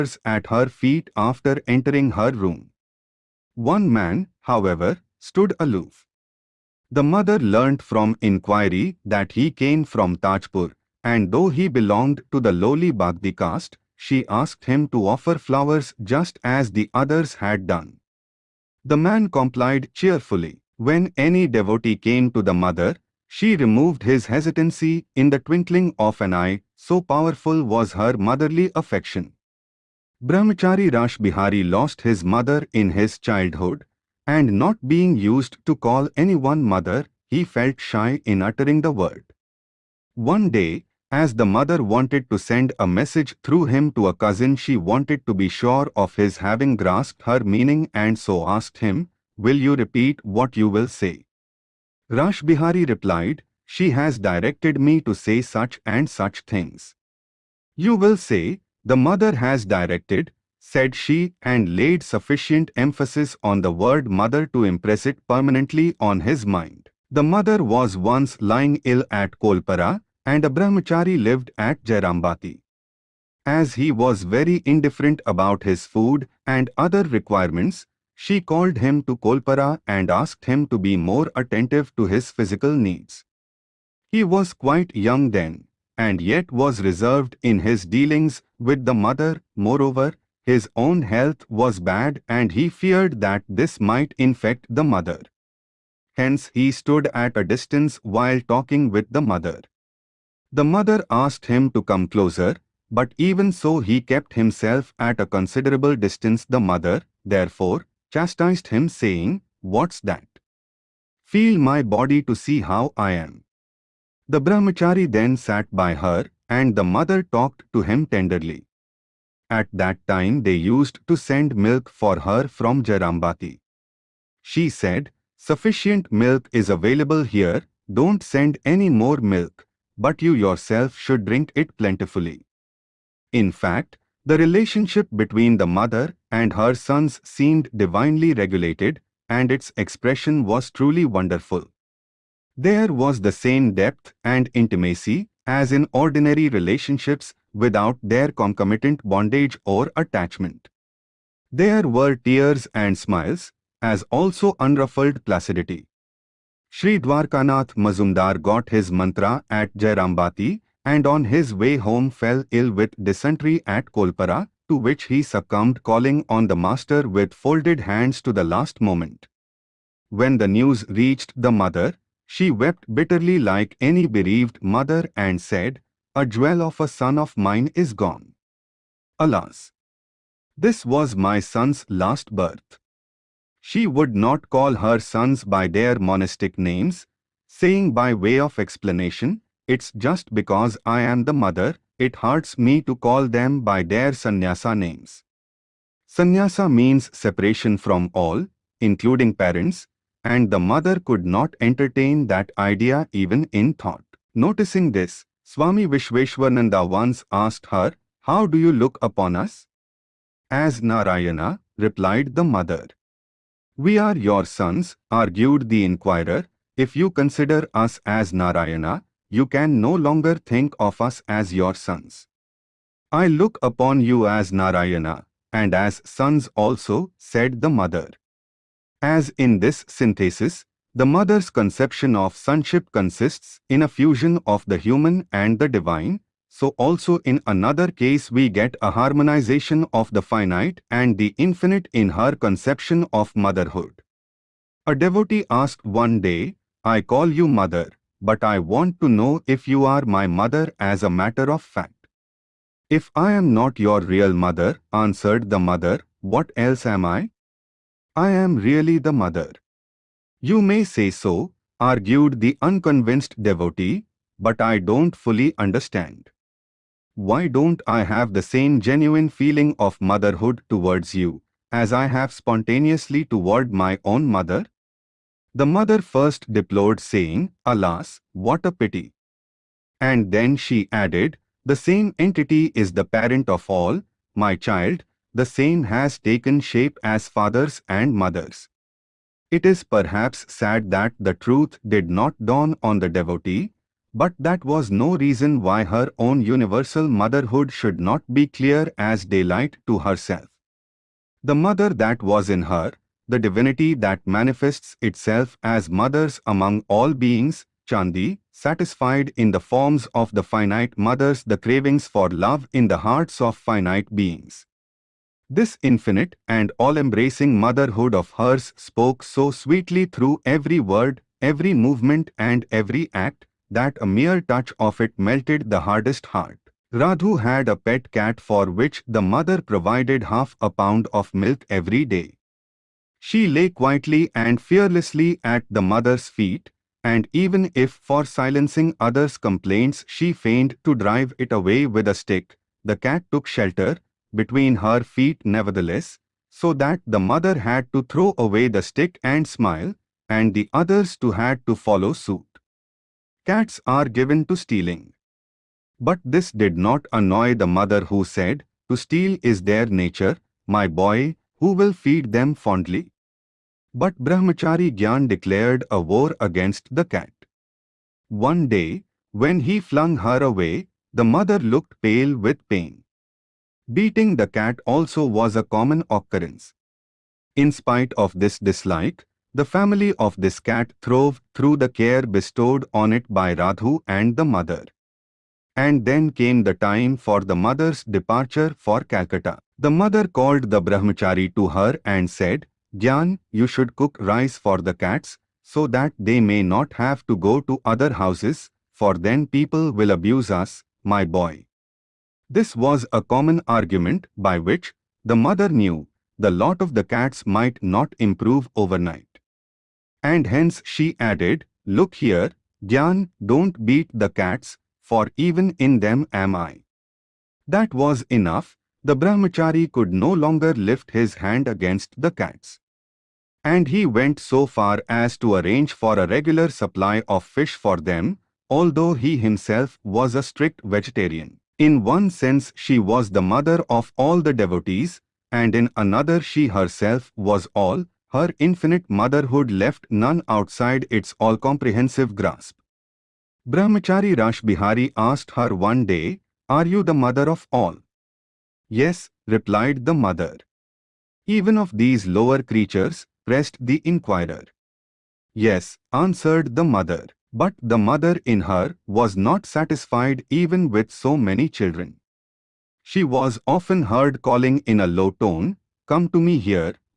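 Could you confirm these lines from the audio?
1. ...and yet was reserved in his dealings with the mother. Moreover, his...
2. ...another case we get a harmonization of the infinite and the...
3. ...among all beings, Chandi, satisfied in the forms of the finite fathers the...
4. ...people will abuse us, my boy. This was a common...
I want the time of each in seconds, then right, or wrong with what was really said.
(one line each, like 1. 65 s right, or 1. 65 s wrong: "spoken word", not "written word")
1. 85 s right
2. 237 s wrong: "finite", not "infinite"
3. 306 s wrong: "mothers", not "fathers"
4. 399 s right.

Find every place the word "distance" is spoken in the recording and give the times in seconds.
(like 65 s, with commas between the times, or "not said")
97 s, 105 s.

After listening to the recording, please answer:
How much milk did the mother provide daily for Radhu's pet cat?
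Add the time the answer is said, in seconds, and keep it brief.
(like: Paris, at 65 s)
half a pound, at 330 s.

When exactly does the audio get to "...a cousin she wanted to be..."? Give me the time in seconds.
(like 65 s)
44 s.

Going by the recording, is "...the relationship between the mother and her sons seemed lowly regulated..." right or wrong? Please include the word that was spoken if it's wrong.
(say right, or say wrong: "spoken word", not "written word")
wrong: "divinely", not "lowly".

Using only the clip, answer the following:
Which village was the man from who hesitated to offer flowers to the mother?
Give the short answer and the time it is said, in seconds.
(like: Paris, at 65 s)
Tajpur, at 10 s.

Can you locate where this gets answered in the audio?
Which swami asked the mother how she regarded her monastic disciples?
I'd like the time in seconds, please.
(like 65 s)
205 s.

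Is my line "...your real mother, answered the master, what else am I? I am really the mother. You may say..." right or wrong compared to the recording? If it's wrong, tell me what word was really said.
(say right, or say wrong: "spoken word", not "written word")
wrong: "mother", not "master".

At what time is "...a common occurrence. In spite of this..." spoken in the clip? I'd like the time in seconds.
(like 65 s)
375 s.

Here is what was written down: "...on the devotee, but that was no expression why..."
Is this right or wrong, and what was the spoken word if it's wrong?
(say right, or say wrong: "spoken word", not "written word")
wrong: "reason", not "expression".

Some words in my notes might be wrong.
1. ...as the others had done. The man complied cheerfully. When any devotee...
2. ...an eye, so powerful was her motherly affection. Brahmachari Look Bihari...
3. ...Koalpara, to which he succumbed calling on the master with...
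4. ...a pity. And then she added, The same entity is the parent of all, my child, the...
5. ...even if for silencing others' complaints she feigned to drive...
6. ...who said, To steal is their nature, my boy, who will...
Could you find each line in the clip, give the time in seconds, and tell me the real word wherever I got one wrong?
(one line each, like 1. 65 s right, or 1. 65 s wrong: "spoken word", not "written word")
1. 16 s right
2. 26 s wrong: "Rash", not "Look"
3. 163 s right
4. 278 s right
5. 337 s right
6. 358 s right.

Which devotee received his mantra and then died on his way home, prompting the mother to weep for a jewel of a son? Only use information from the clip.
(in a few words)
Dwarkanath Mazumdar.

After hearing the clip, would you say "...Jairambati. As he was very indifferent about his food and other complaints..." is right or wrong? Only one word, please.
wrong.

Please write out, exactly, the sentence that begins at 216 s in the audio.
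If you consider us as Narayana, you can no longer think of us as your sons.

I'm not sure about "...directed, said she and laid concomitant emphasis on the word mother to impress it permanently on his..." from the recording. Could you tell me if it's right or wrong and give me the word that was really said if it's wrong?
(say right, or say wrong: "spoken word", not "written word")
wrong: "sufficient", not "concomitant".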